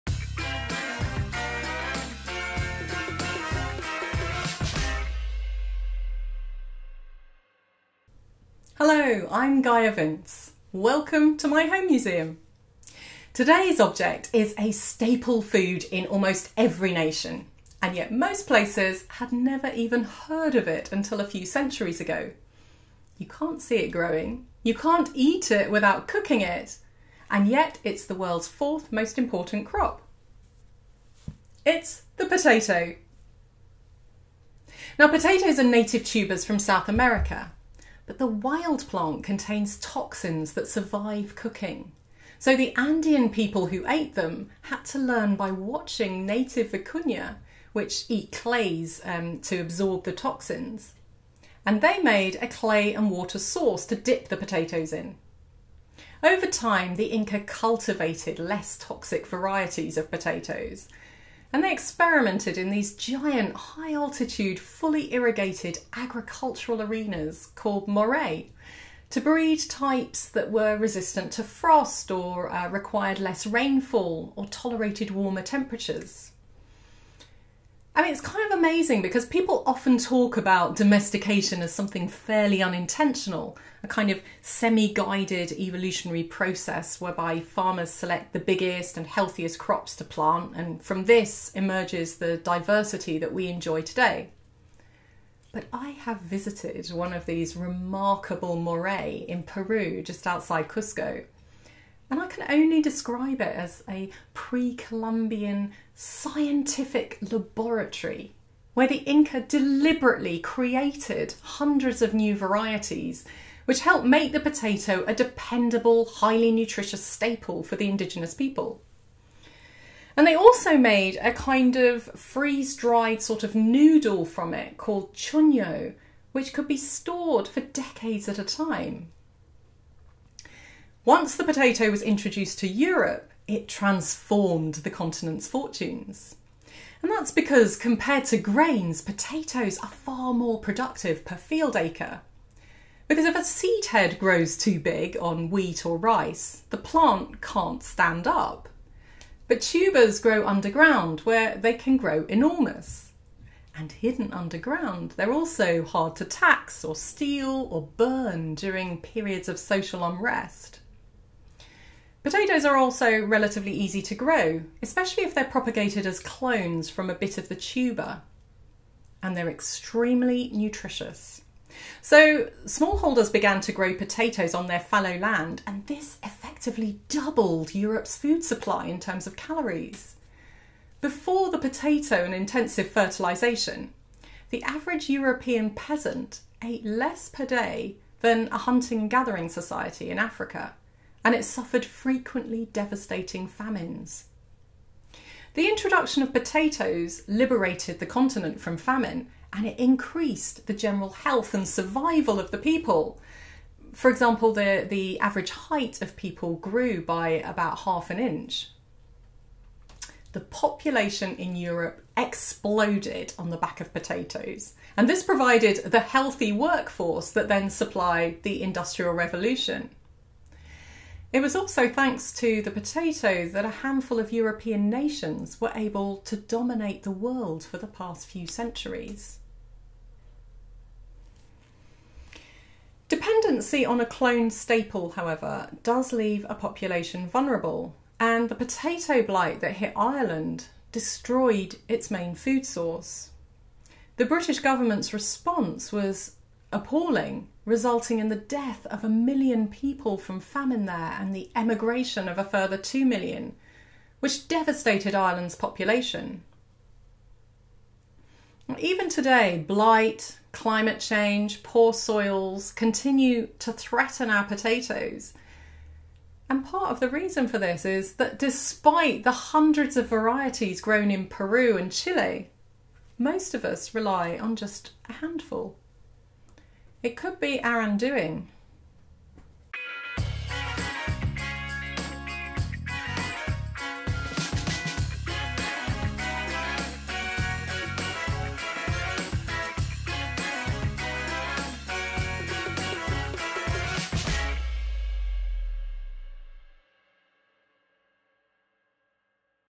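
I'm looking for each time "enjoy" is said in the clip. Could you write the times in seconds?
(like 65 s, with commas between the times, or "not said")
93 s.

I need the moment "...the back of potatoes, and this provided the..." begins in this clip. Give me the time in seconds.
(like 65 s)
213 s.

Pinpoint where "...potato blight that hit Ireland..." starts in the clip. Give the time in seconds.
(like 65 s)
238 s.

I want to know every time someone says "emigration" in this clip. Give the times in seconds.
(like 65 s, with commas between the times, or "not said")
251 s.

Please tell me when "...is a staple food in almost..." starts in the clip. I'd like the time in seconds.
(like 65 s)
14 s.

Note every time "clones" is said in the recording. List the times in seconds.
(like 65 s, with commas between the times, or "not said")
166 s, 234 s.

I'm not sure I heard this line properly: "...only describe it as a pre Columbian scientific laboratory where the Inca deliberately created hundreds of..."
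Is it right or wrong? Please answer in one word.
right.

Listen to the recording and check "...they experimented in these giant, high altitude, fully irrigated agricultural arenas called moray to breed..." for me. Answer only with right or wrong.
right.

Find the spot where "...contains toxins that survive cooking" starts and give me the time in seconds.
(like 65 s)
39 s.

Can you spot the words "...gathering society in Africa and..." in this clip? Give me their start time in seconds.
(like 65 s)
189 s.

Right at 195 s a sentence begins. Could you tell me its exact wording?
The introduction of potatoes liberated the continent from famine and it increased the general health and survival of the people.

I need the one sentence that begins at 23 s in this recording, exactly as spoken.
You can't see it growing, you can't eat it without cooking it, and yet it's the world's fourth most important crop.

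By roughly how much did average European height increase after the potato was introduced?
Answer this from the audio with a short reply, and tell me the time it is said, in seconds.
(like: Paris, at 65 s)
Half an inch, at 207 s.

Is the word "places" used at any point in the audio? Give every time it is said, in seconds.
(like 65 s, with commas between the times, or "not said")
18 s.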